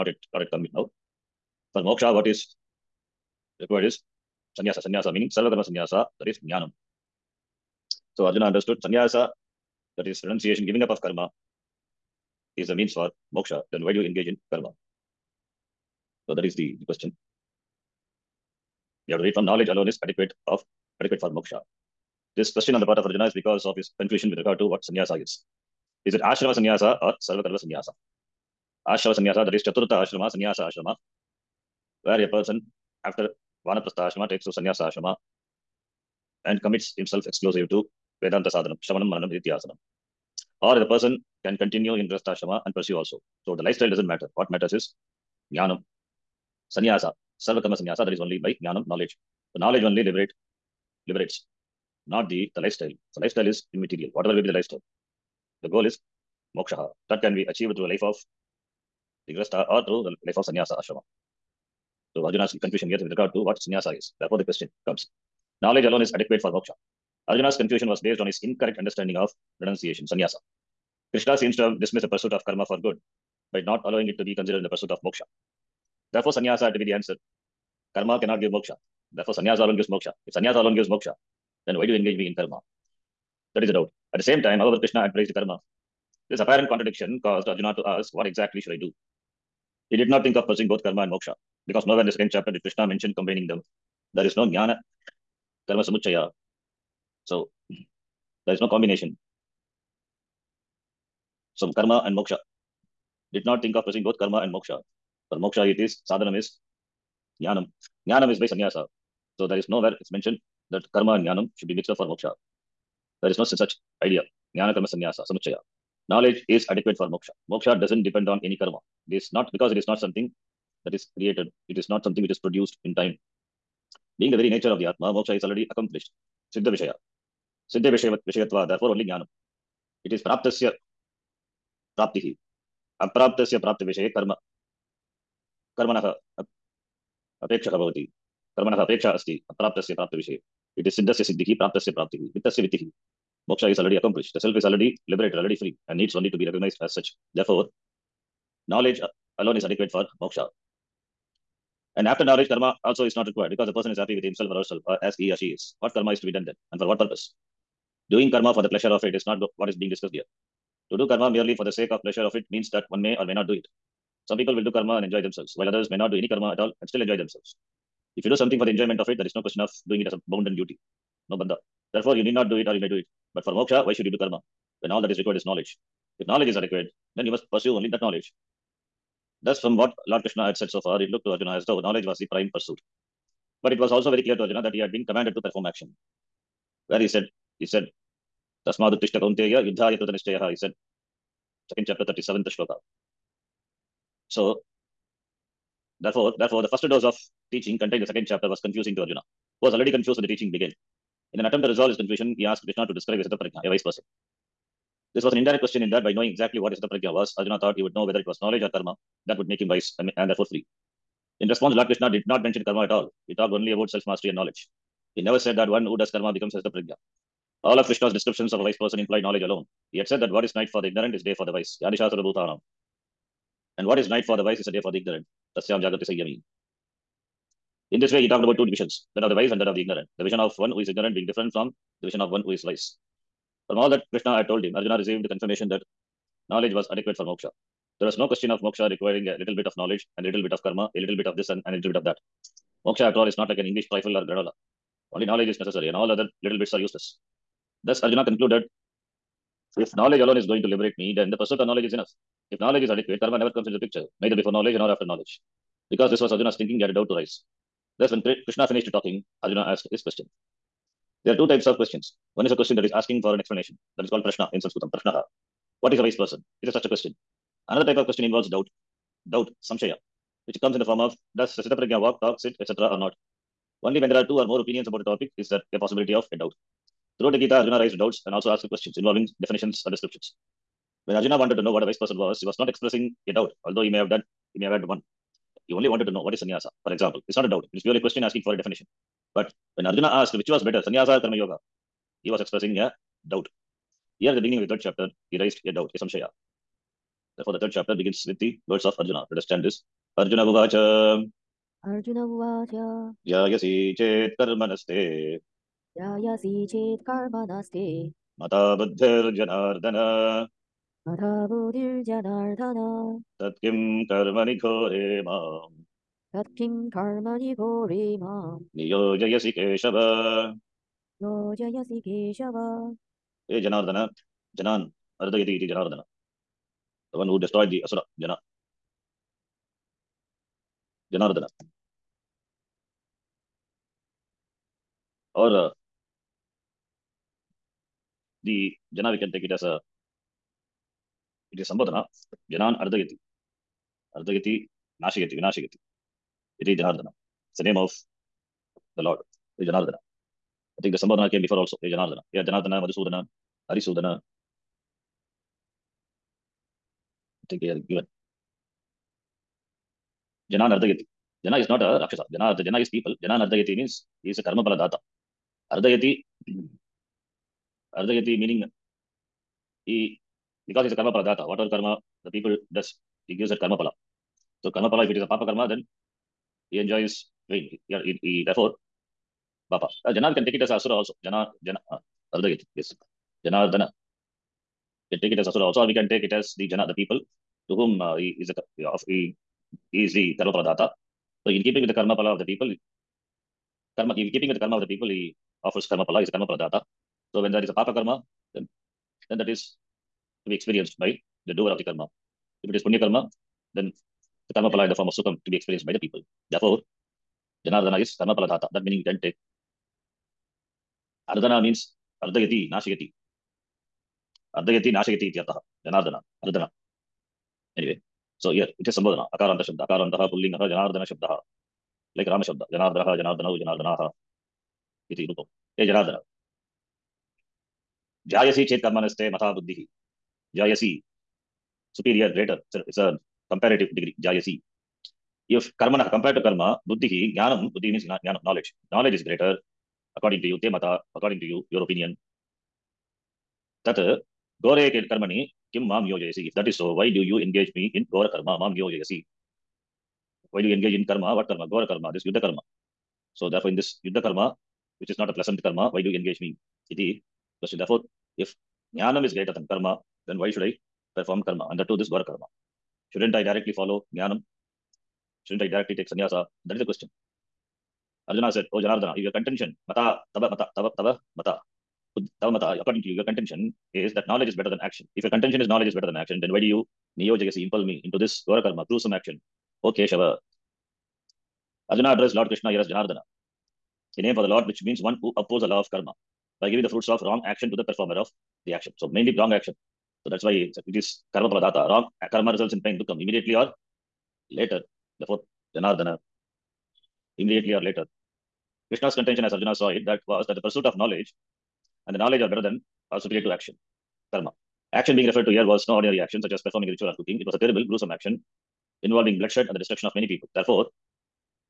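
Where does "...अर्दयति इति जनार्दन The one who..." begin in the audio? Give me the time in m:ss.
5:25.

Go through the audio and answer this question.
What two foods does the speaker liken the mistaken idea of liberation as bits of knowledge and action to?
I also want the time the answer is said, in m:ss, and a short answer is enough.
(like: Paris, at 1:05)
English trifle or granola, at 4:03.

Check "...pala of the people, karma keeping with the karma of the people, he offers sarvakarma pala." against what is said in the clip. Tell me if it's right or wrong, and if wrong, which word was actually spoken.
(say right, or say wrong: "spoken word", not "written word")
wrong: "karma", not "sarvakarma".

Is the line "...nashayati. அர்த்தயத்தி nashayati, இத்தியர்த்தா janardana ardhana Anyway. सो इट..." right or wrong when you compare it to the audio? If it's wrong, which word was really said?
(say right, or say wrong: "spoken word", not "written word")
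right.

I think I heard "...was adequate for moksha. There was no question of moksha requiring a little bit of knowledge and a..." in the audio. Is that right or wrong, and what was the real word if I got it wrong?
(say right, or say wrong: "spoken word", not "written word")
right.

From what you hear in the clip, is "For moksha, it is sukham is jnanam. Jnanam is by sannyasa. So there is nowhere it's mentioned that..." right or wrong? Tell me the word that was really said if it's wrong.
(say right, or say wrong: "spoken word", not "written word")
wrong: "sadhanam", not "sukham".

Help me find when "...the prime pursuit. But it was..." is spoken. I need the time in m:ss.
3:02.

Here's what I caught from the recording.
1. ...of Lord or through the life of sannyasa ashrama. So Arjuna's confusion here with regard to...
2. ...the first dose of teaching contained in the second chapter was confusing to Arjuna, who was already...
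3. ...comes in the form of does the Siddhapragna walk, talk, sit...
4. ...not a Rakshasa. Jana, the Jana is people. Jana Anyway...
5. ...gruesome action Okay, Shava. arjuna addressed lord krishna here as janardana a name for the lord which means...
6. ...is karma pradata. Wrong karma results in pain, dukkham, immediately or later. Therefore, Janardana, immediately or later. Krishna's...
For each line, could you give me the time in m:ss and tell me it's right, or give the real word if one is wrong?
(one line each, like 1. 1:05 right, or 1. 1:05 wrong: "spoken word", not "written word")
1. 0:58 wrong: "Digrasta", not "Lord"
2. 3:16 right
3. 4:30 right
4. 6:01 wrong: "Nardayati", not "Anyway"
5. 7:58 right
6. 8:11 right.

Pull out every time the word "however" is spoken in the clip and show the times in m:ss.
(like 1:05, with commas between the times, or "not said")
1:24.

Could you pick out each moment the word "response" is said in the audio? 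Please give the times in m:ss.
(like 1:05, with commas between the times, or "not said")
3:31.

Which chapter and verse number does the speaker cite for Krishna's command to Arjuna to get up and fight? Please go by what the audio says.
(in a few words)
Second chapter, 37th shloka.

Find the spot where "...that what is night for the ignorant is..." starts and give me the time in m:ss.
3:40.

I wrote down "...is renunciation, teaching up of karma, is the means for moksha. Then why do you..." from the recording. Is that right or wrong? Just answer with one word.
wrong.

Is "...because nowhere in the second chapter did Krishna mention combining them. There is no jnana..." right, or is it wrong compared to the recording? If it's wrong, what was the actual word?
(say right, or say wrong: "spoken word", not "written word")
right.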